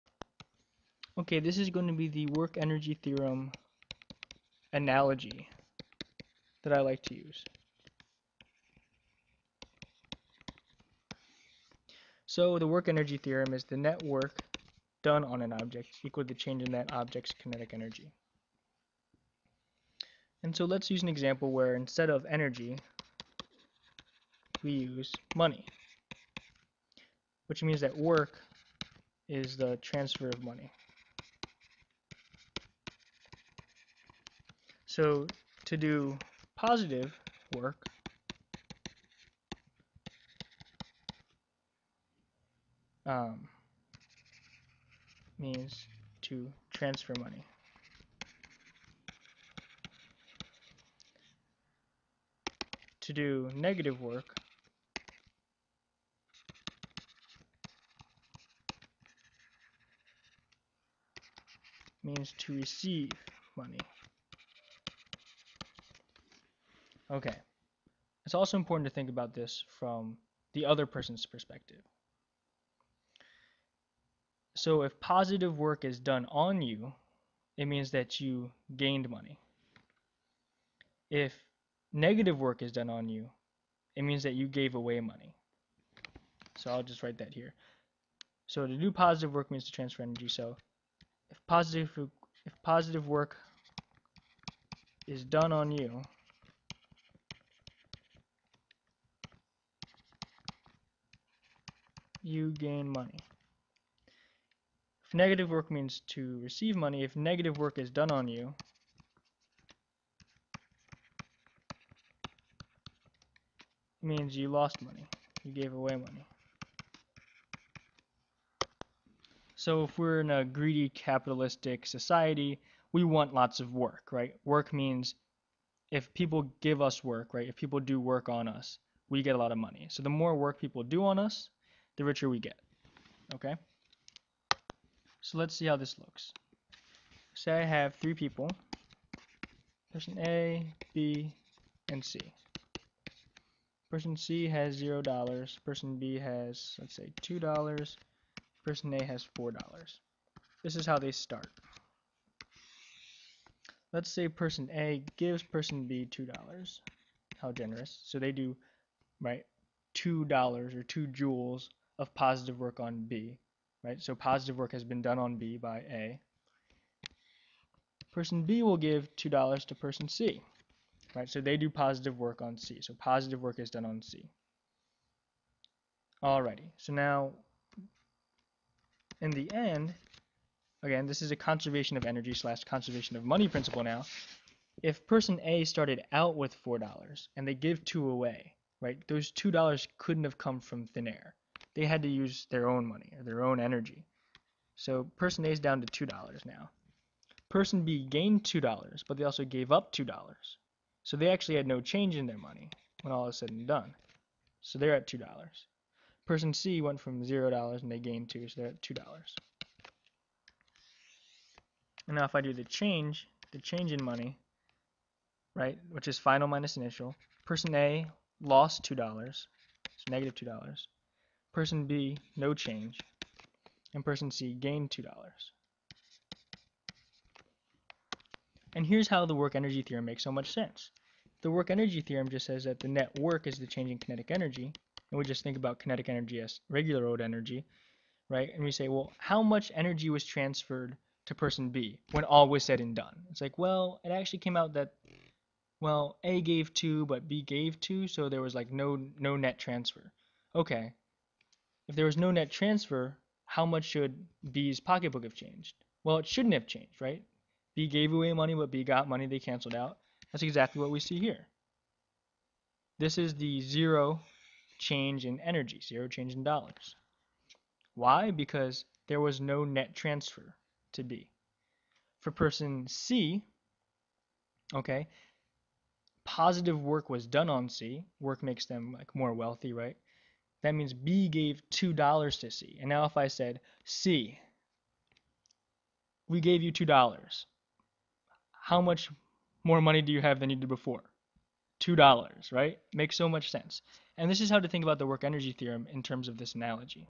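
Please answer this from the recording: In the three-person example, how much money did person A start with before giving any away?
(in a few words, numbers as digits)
$4.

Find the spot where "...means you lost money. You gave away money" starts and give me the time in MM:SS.
01:54.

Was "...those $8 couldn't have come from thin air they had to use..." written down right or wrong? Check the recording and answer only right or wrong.
wrong.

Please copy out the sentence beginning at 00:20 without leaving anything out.
And so let's use an example where instead of energy, we use money, which means that work is the transfer of money.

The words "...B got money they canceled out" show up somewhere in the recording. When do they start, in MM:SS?
04:18.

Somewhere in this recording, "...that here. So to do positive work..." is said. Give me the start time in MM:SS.
01:27.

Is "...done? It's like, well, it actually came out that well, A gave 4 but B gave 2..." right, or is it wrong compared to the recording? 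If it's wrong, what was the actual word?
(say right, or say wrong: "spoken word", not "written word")
wrong: "2", not "4".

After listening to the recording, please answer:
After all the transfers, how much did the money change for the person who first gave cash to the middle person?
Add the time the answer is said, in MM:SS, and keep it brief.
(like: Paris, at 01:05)
-$2, at 03:40.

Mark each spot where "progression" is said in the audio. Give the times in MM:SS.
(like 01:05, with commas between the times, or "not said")
not said.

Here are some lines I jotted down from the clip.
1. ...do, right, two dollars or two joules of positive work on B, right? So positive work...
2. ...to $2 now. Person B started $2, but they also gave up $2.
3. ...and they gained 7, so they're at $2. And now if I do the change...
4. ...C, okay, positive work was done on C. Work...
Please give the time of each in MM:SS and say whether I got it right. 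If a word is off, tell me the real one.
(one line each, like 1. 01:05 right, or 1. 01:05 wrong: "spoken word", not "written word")
1. 02:38 right
2. 03:15 wrong: "gained", not "started"
3. 03:27 wrong: "2", not "7"
4. 04:32 right.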